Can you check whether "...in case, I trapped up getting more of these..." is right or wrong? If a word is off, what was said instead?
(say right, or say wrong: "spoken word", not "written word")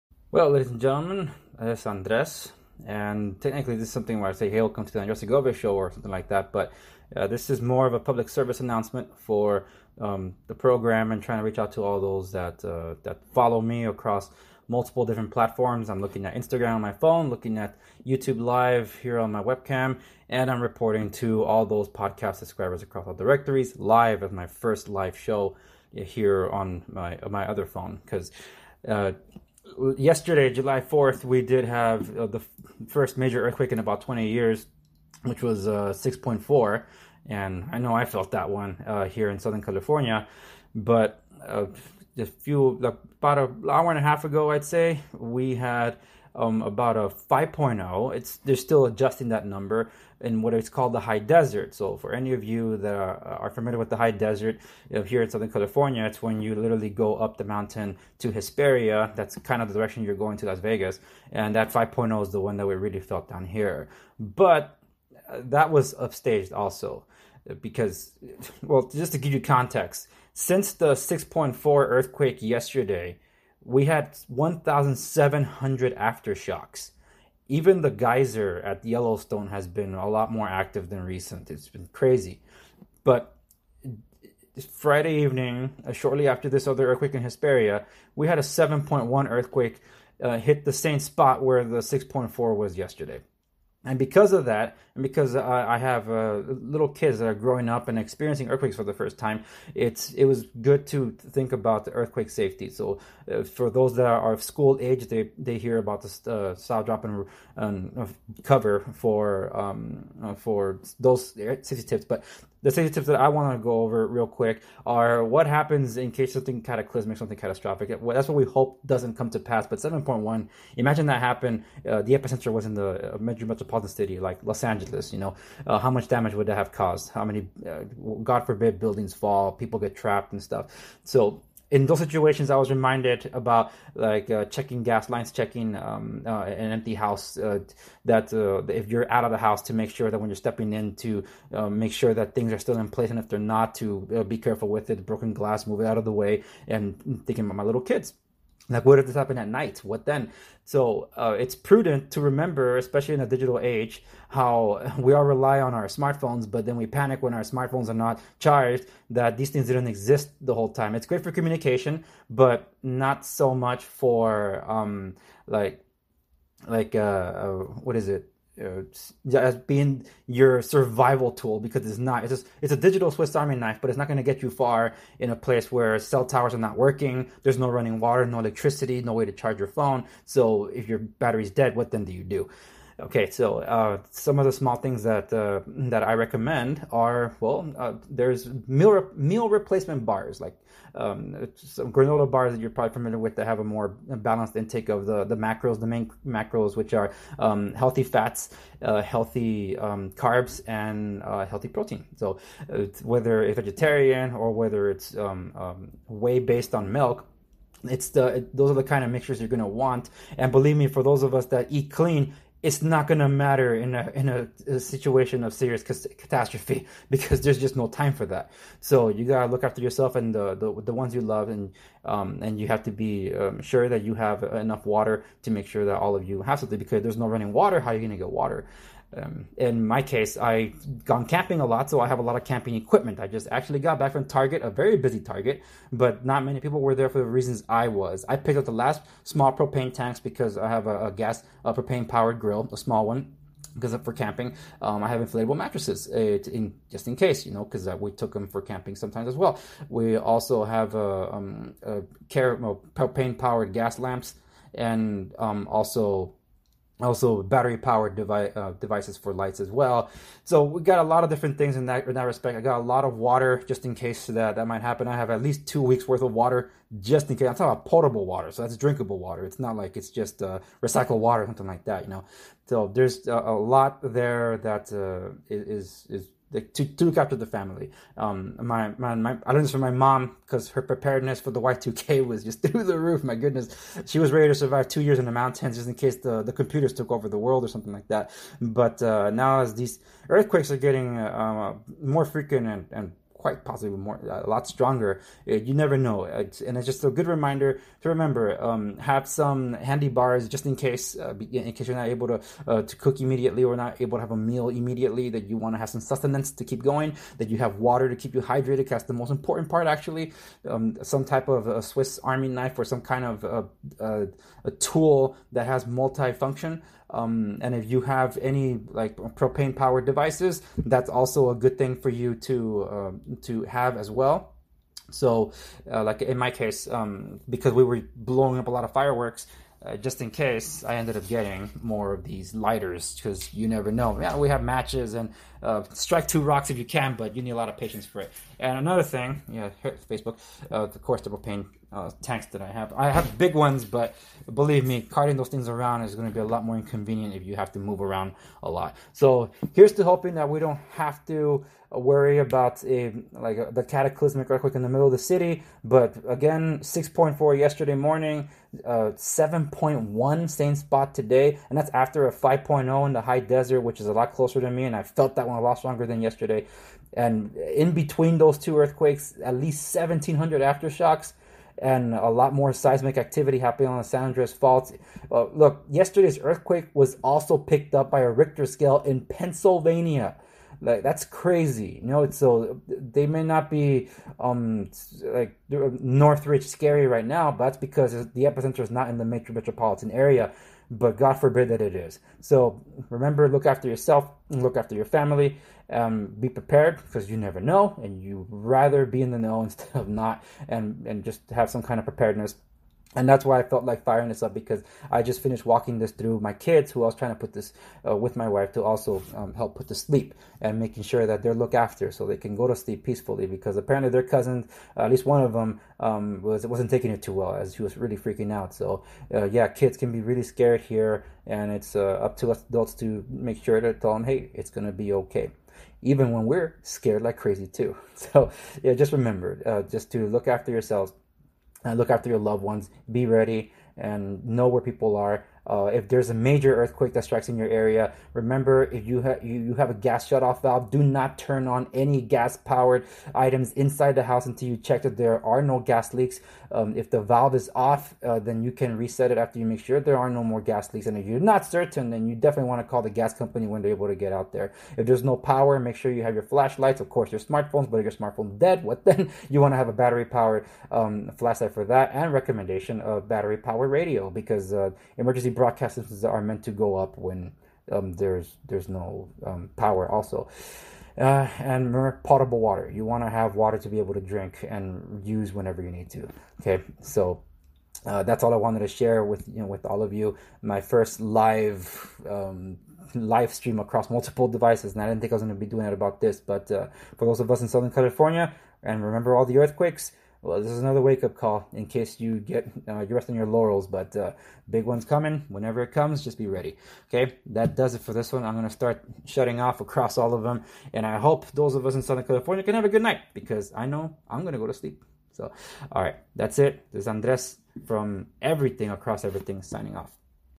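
wrong: "ended", not "trapped".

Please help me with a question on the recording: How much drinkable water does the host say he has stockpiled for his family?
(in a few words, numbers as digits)
two weeks worth.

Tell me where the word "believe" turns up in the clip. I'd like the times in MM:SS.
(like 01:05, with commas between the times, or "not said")
03:30, 05:44.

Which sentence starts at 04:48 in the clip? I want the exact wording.
But uh, now as these earthquakes are getting uh, more frequent and, and quite possibly more a lot stronger.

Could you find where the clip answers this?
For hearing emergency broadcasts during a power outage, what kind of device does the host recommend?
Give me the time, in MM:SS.
07:43.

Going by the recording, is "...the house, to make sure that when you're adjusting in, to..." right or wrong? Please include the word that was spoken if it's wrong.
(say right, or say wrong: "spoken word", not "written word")
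wrong: "stepping", not "adjusting".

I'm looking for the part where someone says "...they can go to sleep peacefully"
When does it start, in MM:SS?
06:52.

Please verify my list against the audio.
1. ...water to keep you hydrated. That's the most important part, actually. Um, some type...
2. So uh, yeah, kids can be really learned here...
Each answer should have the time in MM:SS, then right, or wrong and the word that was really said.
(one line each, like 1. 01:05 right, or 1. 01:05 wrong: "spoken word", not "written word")
1. 05:07 right
2. 06:58 wrong: "scared", not "learned".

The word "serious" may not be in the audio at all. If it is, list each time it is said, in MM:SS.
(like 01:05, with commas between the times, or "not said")
03:35.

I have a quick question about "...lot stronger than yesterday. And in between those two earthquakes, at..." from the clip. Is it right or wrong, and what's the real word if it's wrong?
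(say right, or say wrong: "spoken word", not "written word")
right.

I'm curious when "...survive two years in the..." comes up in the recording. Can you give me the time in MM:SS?
04:44.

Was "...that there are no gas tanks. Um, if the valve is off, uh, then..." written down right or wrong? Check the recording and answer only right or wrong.
wrong.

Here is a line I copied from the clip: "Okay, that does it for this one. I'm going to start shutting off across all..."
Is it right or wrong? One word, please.
right.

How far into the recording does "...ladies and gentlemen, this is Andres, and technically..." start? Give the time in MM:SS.
00:00.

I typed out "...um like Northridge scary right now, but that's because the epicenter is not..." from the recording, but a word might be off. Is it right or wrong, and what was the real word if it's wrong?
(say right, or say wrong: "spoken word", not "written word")
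right.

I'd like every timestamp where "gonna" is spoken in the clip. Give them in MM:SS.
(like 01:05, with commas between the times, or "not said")
03:48, 07:04.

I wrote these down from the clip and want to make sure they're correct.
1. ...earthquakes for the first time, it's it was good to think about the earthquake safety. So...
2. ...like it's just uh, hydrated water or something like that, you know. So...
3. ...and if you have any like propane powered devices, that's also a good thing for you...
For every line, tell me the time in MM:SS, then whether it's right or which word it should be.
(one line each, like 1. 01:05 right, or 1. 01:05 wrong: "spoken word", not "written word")
1. 01:38 right
2. 04:29 wrong: "recycled", not "hydrated"
3. 05:17 right.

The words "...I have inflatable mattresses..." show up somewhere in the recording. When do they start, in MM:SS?
04:05.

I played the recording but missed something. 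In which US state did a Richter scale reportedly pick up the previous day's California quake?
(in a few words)
Pennsylvania.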